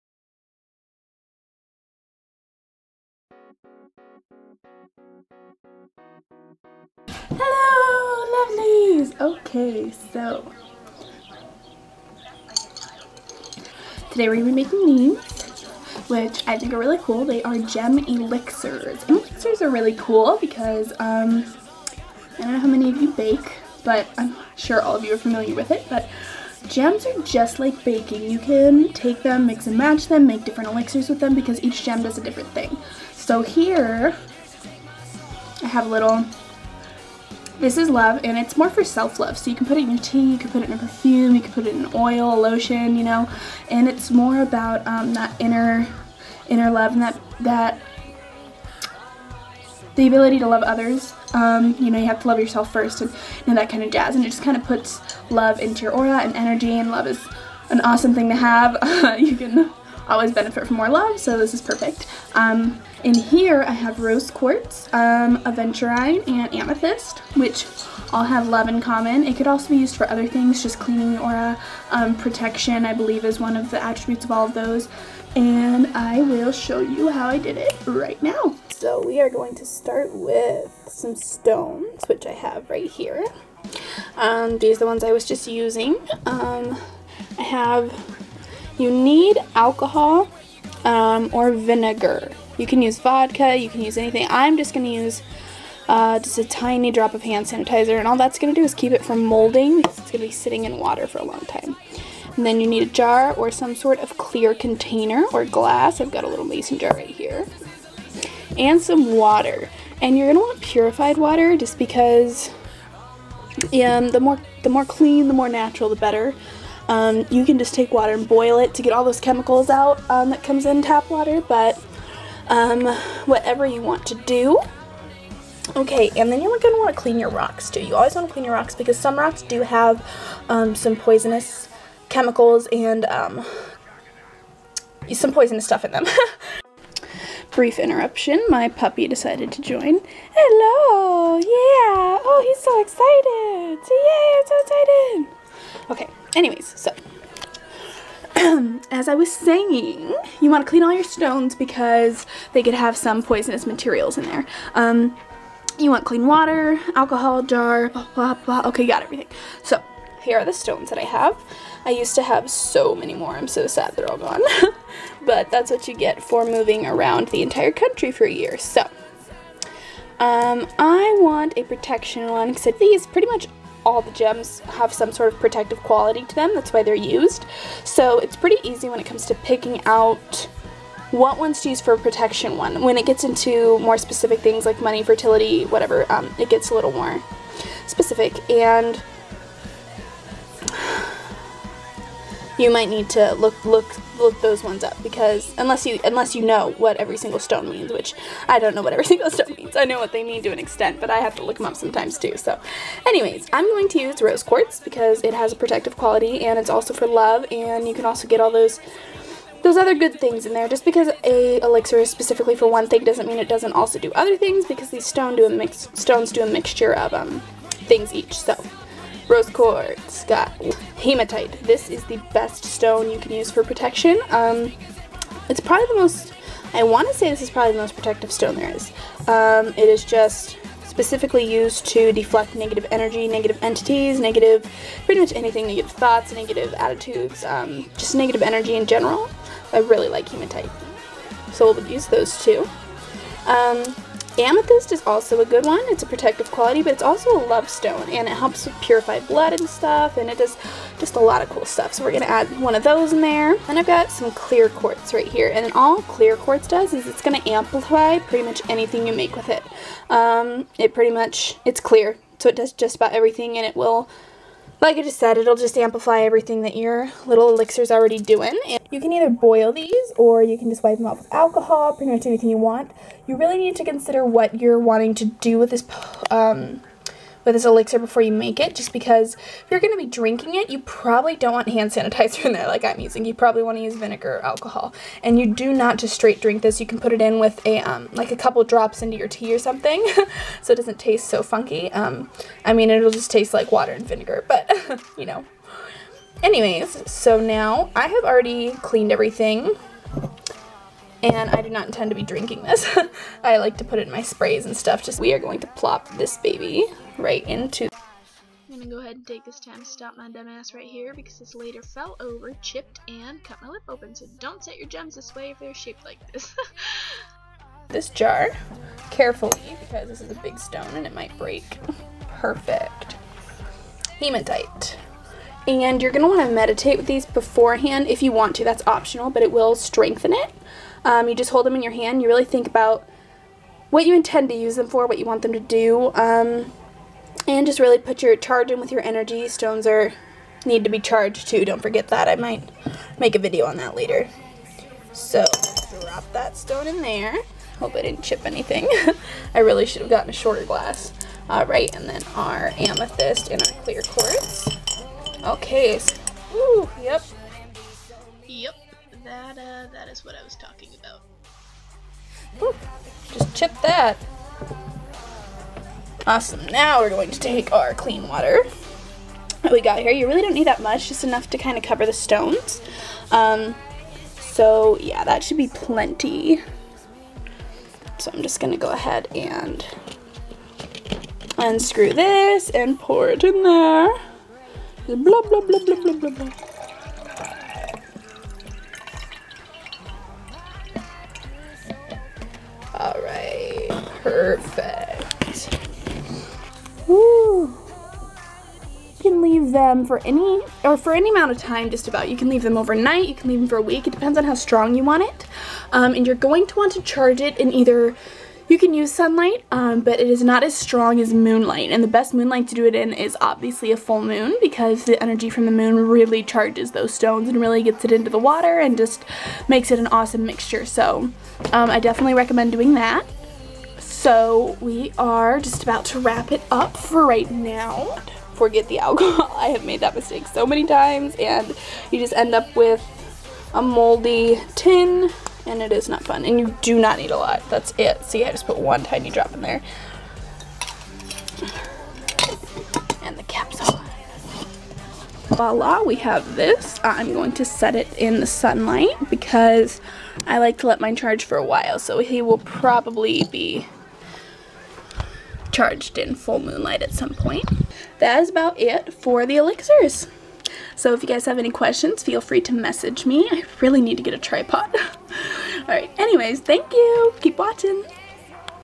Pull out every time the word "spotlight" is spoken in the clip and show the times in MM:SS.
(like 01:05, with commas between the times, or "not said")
not said.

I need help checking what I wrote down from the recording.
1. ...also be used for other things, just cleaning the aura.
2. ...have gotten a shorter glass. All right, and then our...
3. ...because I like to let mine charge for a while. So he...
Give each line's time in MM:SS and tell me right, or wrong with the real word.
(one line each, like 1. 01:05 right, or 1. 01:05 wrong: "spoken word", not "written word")
1. 01:09 right
2. 05:50 right
3. 07:29 right.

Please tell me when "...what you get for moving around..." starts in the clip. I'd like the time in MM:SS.
02:45.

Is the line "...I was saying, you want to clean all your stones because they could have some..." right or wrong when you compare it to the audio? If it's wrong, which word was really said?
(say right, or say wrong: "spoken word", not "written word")
right.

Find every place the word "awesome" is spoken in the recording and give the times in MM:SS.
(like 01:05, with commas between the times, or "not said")
00:57, 06:06, 07:00.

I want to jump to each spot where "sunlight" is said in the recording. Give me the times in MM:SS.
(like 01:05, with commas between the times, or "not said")
06:49, 07:28.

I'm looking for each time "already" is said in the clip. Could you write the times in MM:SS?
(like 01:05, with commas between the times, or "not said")
04:27, 04:58.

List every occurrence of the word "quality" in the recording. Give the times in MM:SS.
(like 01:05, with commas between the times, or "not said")
02:55, 03:25, 04:06.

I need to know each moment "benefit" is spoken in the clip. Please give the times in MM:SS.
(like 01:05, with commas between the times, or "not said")
01:00.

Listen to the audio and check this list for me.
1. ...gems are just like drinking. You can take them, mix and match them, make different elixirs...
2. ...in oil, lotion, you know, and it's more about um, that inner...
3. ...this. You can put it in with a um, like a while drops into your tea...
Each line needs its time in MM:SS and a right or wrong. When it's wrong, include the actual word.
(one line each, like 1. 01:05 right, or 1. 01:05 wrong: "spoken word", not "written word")
1. 00:26 wrong: "baking", not "drinking"
2. 00:41 right
3. 04:46 wrong: "couple", not "while".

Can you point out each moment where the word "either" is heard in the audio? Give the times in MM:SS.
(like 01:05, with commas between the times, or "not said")
04:29, 06:47.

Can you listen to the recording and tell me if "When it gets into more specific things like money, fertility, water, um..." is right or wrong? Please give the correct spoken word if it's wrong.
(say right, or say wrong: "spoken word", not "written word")
wrong: "whatever", not "water".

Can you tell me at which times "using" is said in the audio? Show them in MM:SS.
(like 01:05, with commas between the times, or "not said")
01:25, 04:42.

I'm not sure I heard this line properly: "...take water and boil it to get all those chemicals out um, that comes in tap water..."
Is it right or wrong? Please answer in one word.
right.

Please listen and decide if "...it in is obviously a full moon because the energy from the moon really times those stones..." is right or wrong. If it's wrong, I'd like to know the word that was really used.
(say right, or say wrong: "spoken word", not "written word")
wrong: "charges", not "times".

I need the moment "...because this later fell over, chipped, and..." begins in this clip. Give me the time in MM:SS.
05:11.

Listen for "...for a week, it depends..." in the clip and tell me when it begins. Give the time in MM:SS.
06:43.